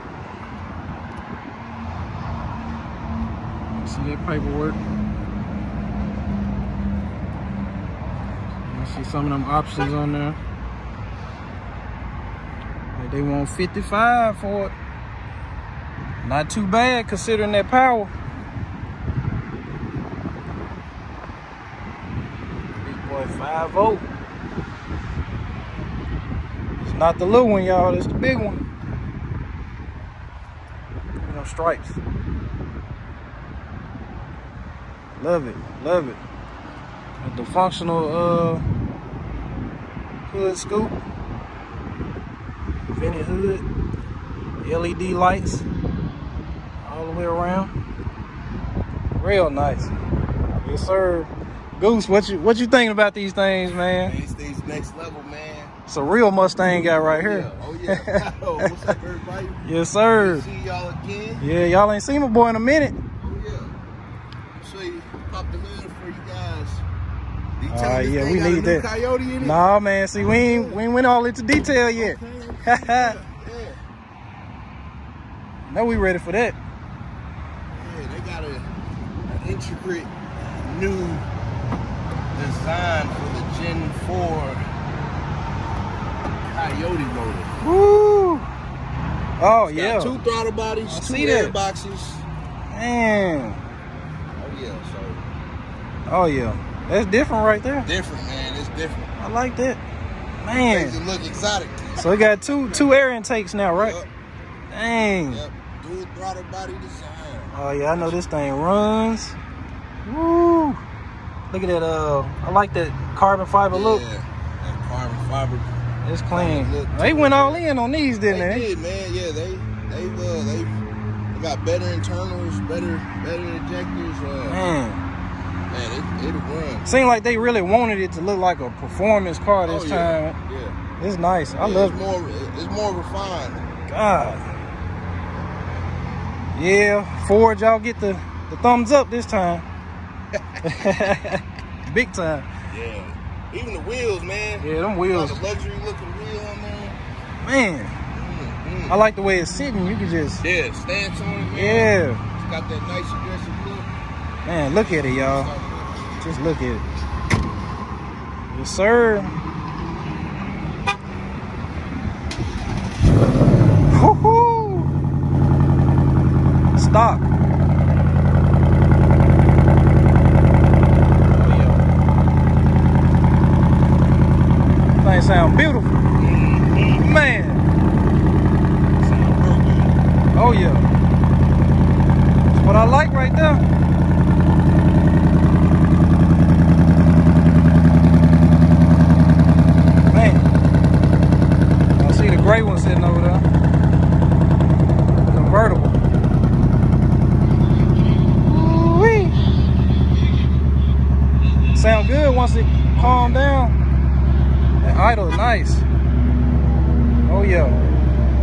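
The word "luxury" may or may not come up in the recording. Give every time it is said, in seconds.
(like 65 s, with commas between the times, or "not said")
145 s.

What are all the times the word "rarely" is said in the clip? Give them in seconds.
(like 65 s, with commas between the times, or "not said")
not said.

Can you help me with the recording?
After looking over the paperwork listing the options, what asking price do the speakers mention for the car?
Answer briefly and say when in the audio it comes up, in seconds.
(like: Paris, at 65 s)
55, at 13 s.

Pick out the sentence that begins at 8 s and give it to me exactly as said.
see some of them options on there.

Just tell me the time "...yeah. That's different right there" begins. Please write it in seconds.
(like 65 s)
96 s.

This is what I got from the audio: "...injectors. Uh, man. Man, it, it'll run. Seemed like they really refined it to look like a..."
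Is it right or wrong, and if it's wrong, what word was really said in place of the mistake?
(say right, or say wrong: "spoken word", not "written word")
wrong: "wanted", not "refined".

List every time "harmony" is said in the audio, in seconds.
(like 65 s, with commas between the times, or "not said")
not said.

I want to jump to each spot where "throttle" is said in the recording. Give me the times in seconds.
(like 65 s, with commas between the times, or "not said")
90 s, 106 s.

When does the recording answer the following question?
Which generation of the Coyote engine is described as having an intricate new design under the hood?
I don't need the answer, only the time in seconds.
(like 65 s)
83 s.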